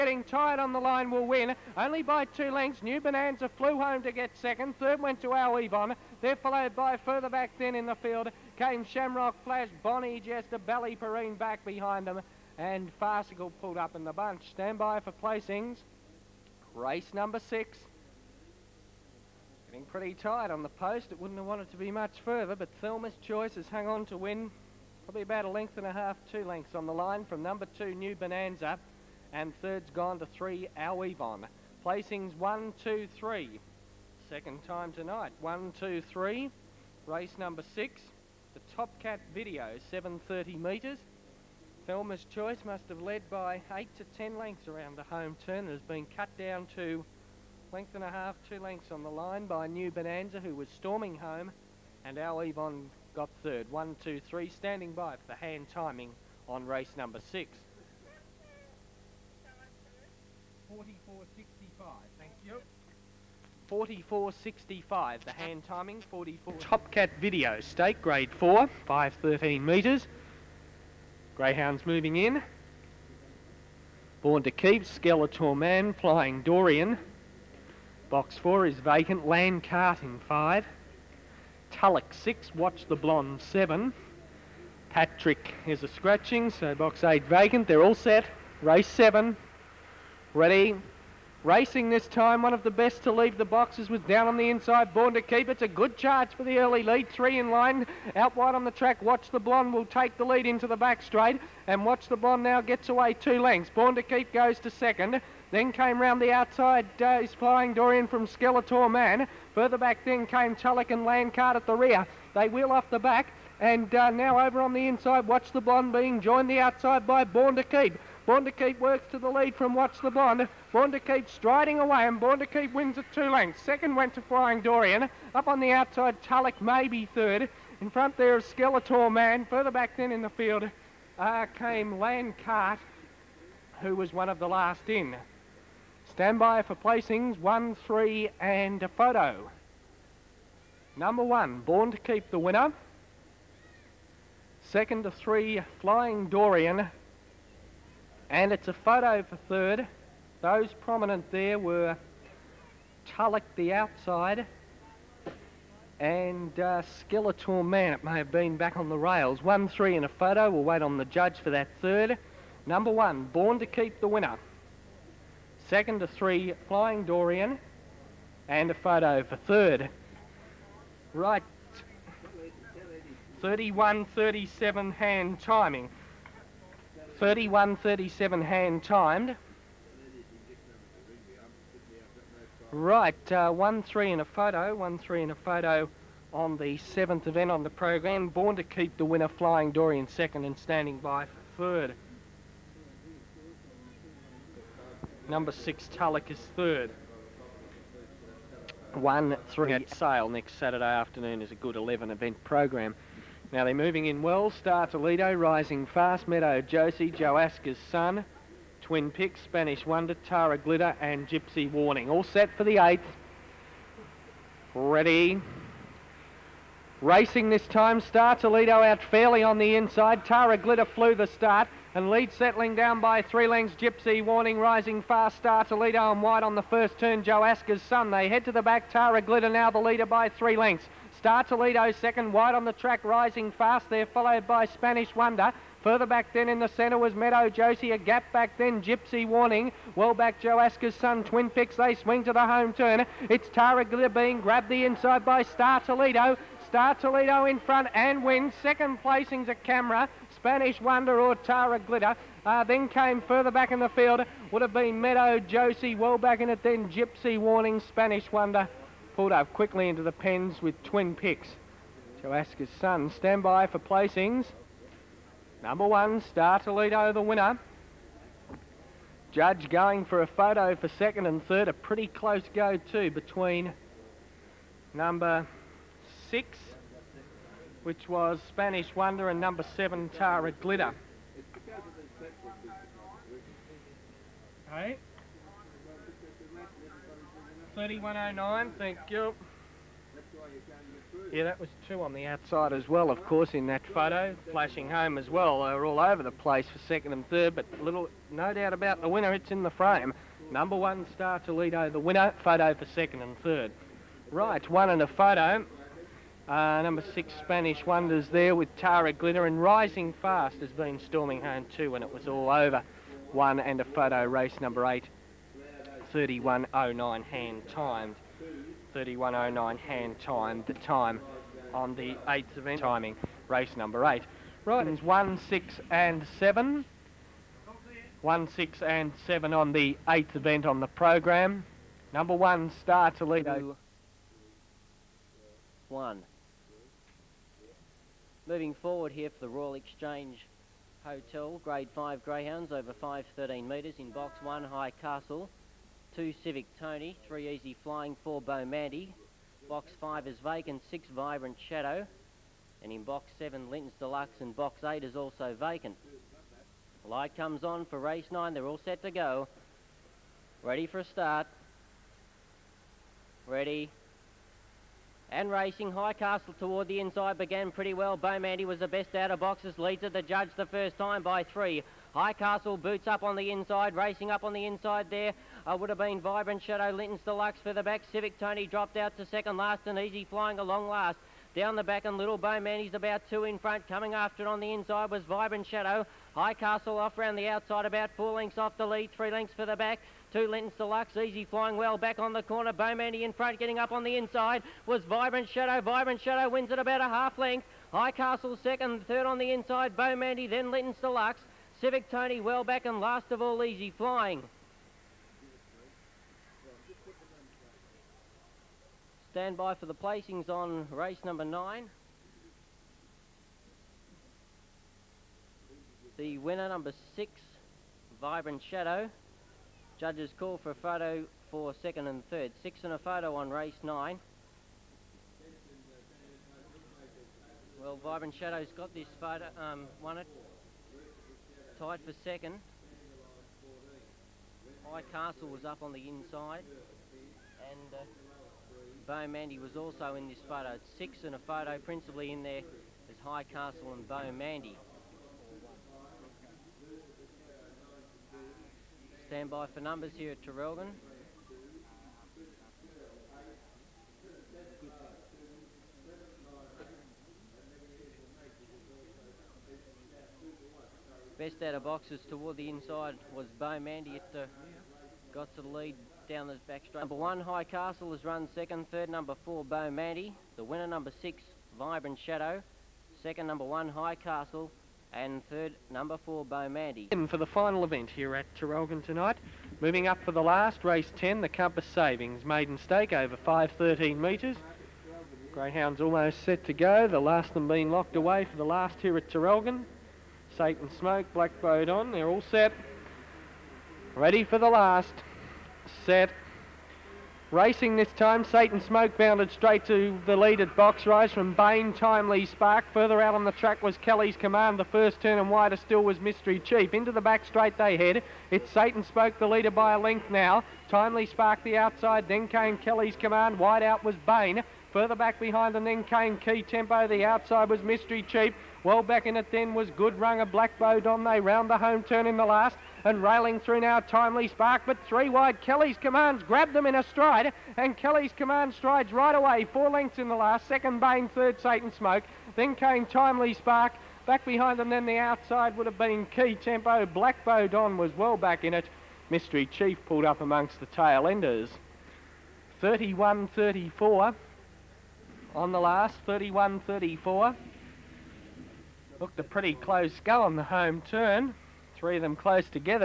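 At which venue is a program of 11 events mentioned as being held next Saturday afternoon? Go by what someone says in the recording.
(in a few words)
Sale.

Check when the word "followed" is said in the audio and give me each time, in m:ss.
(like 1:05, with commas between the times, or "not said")
0:06, 3:54.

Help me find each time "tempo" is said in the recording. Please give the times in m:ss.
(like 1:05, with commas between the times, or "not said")
8:36, 8:56.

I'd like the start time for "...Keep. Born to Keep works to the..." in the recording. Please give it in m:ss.
1:57.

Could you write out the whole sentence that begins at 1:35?
It's a good charge for the early lead.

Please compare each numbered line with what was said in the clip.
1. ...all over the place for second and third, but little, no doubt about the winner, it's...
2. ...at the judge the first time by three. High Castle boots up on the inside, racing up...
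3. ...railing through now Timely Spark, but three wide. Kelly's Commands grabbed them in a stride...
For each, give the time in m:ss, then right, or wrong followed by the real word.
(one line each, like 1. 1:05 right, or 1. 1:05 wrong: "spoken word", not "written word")
1. 4:55 right
2. 6:10 right
3. 8:43 right.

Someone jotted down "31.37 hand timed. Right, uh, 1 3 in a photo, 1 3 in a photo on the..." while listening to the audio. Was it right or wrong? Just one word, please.
right.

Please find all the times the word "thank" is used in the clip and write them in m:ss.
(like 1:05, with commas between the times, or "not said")
1:02, 4:48.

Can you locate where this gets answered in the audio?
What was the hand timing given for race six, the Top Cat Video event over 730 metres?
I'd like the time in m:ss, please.
1:00.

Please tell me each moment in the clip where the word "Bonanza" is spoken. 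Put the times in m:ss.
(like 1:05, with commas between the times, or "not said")
0:02, 0:28, 0:49.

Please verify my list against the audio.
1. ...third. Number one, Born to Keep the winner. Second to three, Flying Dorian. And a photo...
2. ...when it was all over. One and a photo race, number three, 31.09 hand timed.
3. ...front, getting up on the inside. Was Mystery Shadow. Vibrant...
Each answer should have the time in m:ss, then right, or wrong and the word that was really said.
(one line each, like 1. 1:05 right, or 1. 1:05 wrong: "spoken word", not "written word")
1. 2:41 right
2. 5:11 wrong: "eight", not "three"
3. 6:33 wrong: "Vibrant", not "Mystery".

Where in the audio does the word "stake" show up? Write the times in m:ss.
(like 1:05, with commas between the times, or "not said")
1:07, 8:02.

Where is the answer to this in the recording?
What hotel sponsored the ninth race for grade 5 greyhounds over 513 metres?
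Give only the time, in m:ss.
5:39.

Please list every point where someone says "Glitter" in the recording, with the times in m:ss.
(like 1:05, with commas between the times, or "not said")
3:30, 3:40, 3:49, 4:03, 4:11, 4:40, 5:09.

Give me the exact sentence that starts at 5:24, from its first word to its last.
Right, it's one, six and seven.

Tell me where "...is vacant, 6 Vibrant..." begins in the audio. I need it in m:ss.
5:50.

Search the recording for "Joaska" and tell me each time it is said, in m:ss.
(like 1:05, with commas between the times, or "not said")
3:27, 4:22.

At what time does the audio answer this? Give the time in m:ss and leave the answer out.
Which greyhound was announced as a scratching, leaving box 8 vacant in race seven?
1:24.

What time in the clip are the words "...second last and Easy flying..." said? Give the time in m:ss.
6:19.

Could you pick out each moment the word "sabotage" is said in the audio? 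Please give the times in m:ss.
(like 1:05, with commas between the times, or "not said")
not said.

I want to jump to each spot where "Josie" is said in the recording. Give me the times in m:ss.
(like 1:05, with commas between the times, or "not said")
3:26, 3:57, 4:15.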